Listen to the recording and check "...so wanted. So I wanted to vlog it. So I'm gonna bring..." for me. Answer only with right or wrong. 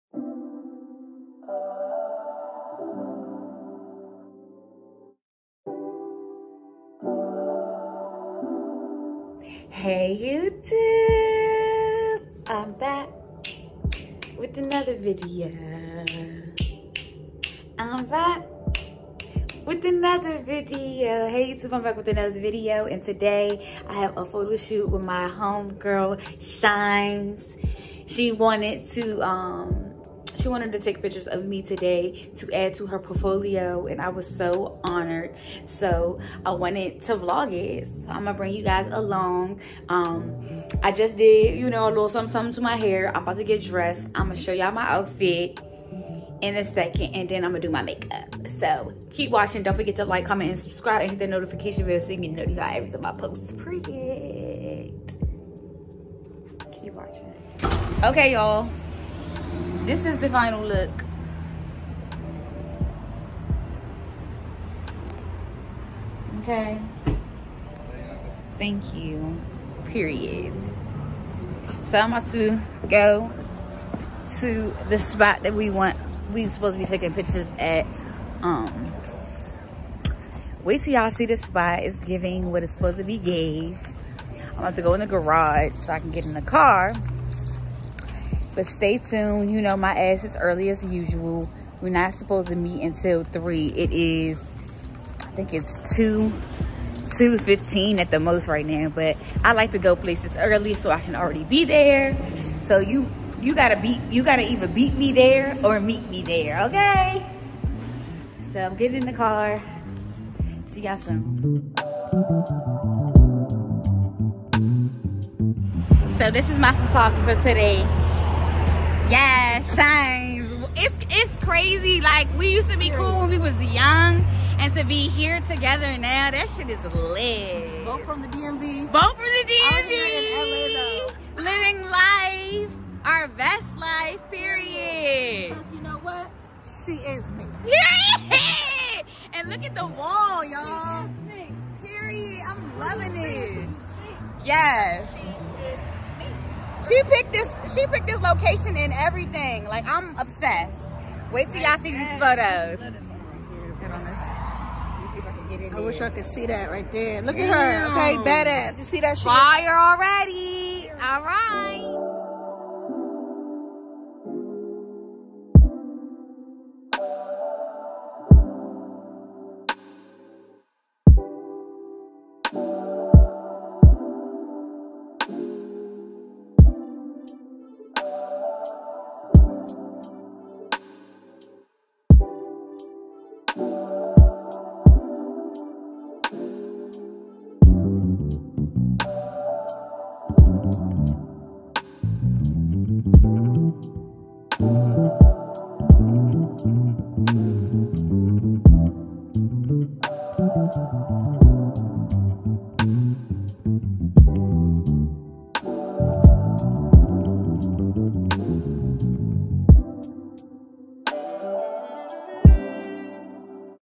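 wrong.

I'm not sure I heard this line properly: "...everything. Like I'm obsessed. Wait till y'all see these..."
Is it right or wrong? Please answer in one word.
right.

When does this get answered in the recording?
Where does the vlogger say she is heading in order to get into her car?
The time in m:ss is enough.
1:25.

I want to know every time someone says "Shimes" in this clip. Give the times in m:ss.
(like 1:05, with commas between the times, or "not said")
0:26, 1:59.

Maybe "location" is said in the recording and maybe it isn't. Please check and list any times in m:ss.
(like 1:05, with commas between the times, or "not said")
2:28.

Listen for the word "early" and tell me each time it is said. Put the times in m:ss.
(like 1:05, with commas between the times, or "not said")
1:30, 1:40.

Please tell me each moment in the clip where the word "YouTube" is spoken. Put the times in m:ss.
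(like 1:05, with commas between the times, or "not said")
0:10, 0:21.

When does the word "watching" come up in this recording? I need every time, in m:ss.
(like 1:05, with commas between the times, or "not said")
0:49, 0:56.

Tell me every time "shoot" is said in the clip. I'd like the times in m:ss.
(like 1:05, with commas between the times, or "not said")
0:24.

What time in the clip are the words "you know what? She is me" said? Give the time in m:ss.
2:15.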